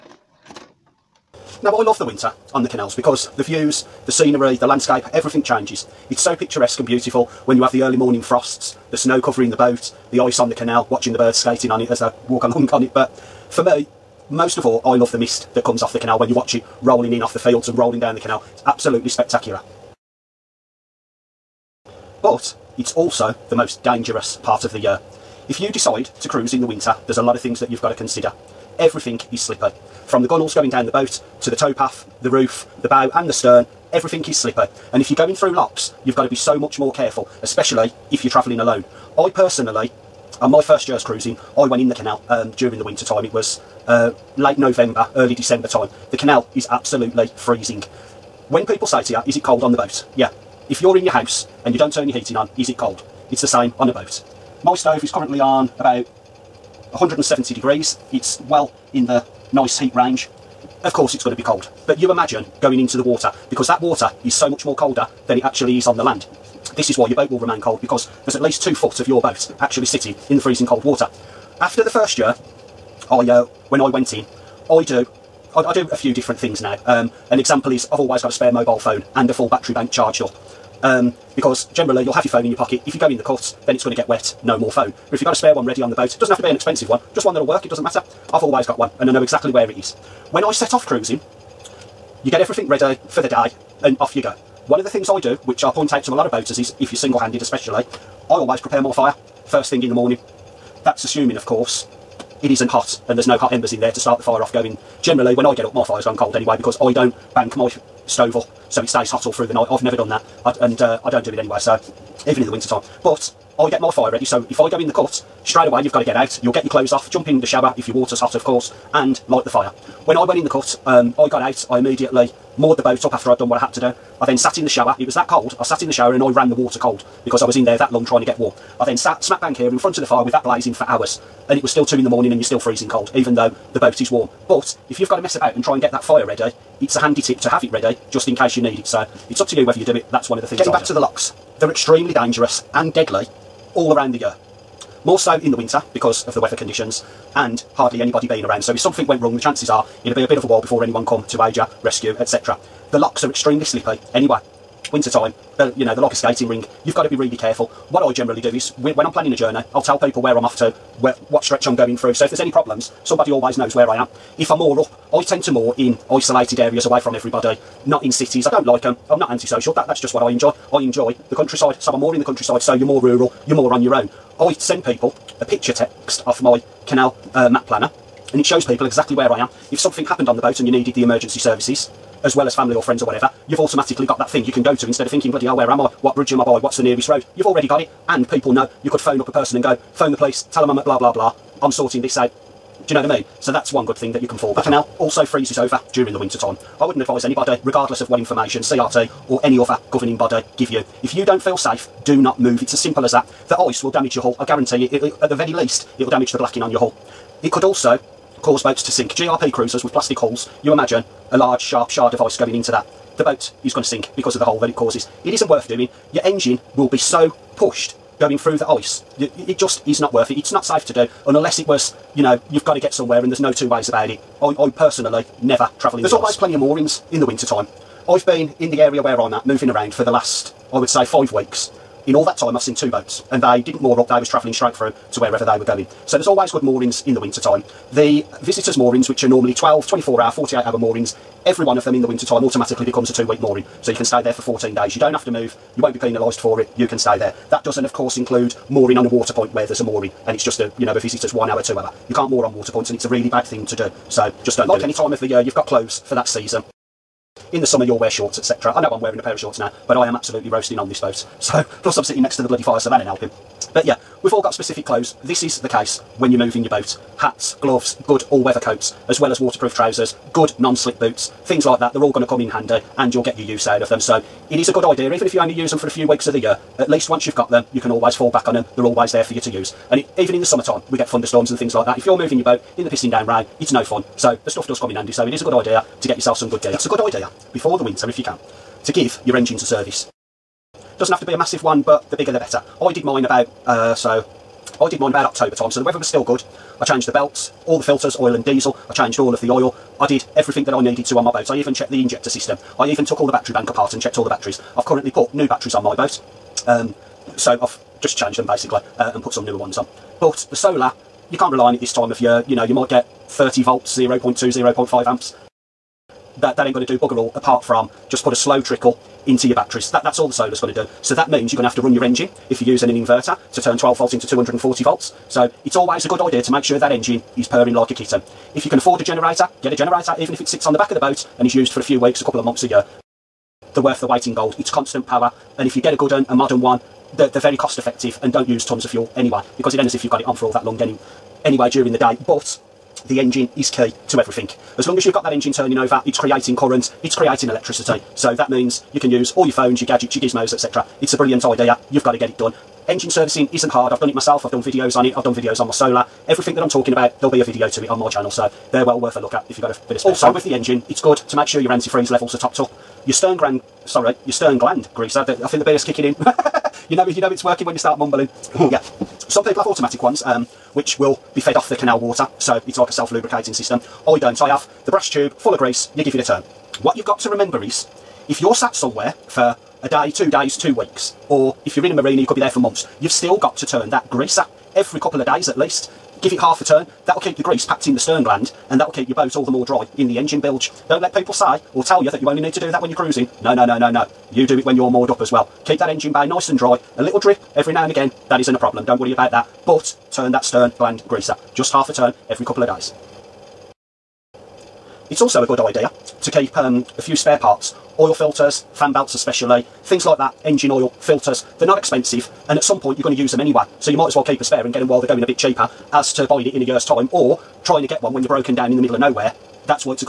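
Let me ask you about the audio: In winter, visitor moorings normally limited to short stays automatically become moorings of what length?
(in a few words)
2 week.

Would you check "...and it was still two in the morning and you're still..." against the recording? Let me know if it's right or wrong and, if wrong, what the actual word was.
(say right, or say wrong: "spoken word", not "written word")
right.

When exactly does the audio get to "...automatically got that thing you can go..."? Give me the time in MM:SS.
03:03.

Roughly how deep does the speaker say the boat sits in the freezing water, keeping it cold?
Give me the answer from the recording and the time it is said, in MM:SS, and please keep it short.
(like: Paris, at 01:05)
2 foot, at 01:08.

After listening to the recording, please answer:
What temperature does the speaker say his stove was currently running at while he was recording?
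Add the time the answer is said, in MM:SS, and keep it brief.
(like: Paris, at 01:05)
170 degrees, at 00:56.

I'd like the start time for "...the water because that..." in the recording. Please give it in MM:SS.
01:02.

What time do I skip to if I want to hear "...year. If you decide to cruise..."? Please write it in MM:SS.
00:24.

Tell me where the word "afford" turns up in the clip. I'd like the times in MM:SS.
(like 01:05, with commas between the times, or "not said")
05:28.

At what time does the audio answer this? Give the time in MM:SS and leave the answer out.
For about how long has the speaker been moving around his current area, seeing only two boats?
03:51.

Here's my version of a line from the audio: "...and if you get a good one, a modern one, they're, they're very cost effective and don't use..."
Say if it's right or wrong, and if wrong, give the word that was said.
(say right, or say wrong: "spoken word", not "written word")
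right.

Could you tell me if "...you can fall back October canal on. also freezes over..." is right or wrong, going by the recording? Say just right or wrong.
wrong.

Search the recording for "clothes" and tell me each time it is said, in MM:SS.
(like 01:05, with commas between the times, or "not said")
01:56, 04:15, 04:24.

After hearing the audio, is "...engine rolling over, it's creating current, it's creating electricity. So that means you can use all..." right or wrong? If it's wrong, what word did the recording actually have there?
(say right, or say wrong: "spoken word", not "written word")
wrong: "turning", not "rolling".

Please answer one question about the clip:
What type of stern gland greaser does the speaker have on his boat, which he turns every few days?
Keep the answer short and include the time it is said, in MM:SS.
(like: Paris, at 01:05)
brass tube, at 06:14.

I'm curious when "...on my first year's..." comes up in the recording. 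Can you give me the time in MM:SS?
00:40.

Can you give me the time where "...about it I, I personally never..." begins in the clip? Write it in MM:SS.
03:43.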